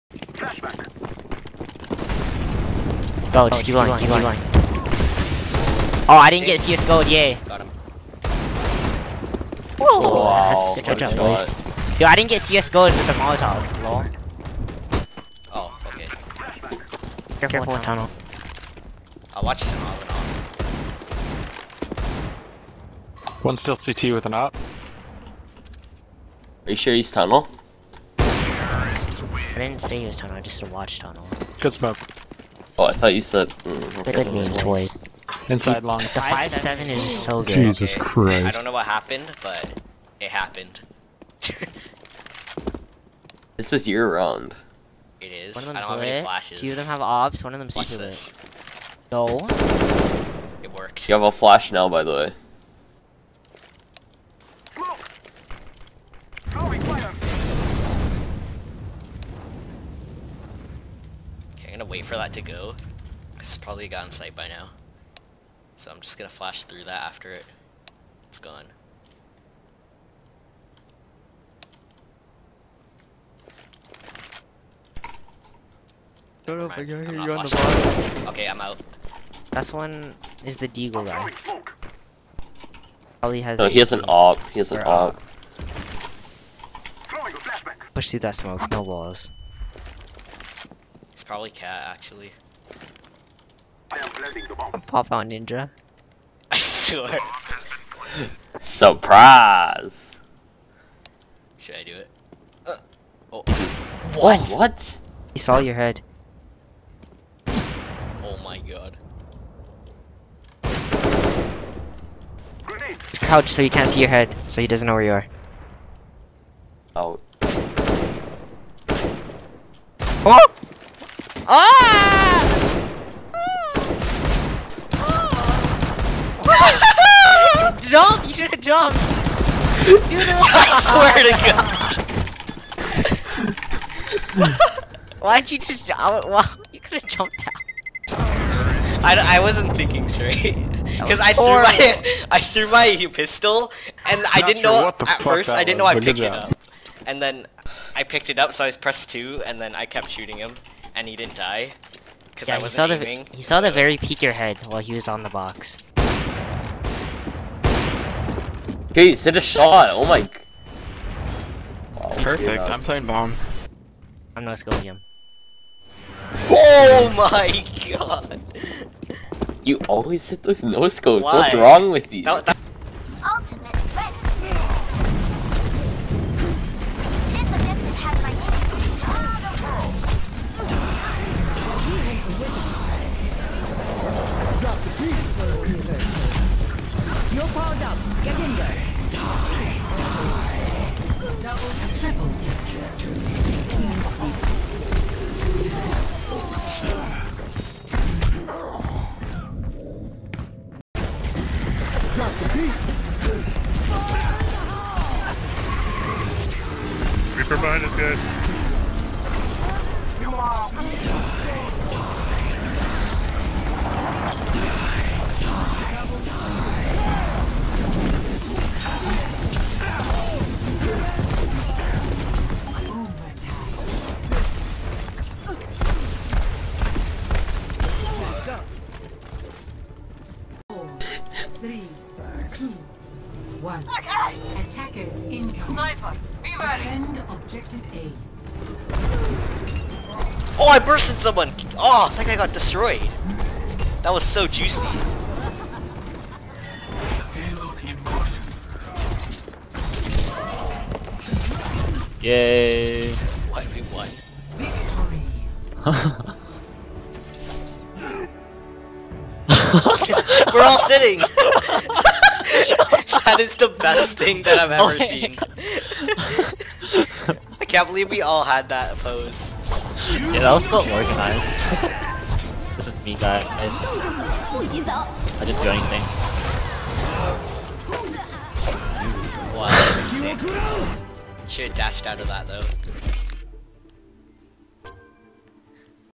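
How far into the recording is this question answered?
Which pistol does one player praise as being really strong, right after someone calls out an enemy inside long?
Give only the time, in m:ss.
0:36.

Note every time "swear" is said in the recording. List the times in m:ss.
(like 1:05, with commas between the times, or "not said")
1:36, 2:11.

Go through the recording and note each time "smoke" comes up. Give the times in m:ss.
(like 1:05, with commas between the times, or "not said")
0:31, 1:28.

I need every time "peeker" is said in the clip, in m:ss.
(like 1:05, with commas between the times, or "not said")
2:33.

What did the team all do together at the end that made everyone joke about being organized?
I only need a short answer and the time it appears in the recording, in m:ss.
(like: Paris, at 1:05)
Sitting, at 4:20.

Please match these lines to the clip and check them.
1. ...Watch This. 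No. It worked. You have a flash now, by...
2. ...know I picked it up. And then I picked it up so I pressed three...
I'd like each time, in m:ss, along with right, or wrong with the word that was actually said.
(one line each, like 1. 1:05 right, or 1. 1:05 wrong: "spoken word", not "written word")
1. 0:47 right
2. 2:25 wrong: "two", not "three".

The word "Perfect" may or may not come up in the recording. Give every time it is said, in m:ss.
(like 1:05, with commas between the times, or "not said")
2:42.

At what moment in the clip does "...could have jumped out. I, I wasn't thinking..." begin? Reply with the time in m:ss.
2:16.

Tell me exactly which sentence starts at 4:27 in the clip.
I can't believe we all had that pose.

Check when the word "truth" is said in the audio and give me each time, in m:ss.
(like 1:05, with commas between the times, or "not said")
not said.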